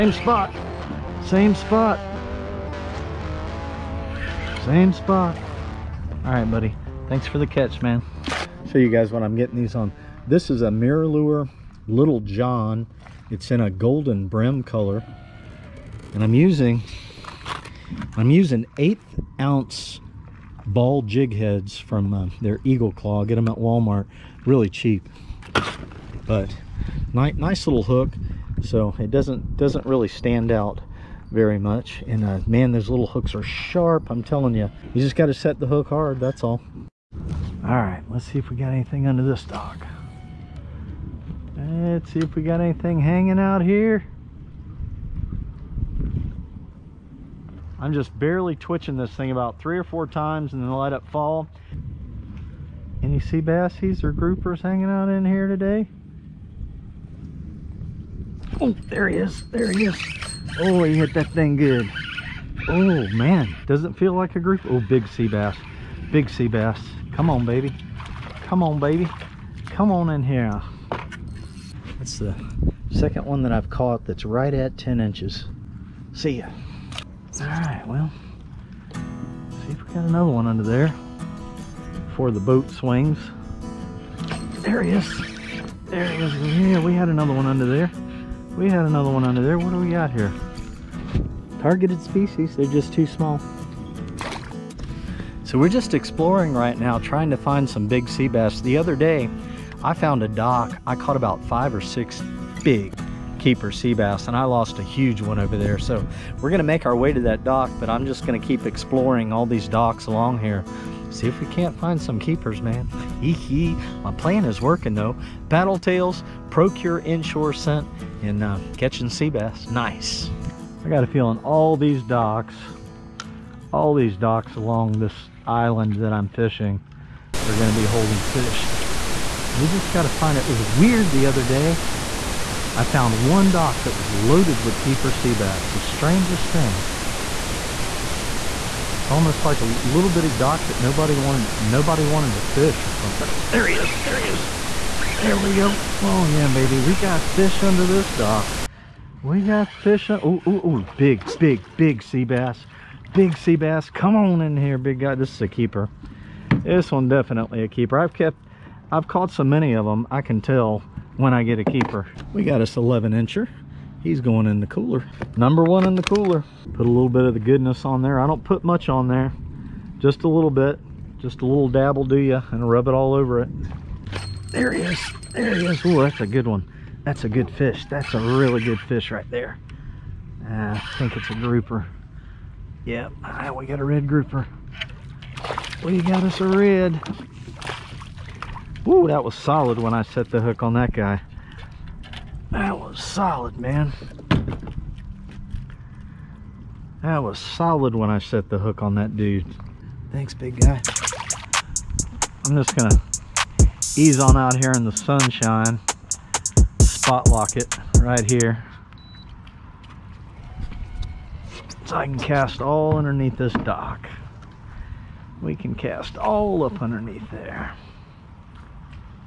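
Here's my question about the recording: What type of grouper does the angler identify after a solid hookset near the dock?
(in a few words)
red grouper.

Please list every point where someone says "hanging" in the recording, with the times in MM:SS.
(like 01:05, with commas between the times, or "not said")
00:43, 00:54.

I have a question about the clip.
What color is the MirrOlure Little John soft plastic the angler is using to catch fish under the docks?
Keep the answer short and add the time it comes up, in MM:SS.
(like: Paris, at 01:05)
golden brim, at 00:13.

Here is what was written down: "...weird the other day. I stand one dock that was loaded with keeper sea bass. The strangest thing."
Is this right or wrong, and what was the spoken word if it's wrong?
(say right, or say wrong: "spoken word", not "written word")
wrong: "found", not "stand".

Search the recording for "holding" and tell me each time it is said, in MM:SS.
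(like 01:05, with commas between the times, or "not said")
02:07.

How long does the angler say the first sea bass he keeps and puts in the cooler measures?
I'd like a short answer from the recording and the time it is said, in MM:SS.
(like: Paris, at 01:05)
11 inches, at 02:42.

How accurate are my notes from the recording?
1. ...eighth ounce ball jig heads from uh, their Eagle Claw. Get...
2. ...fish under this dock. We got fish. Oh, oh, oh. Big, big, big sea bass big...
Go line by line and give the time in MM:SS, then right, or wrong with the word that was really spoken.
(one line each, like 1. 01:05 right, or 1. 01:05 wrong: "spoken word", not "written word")
1. 00:18 right
2. 02:27 right.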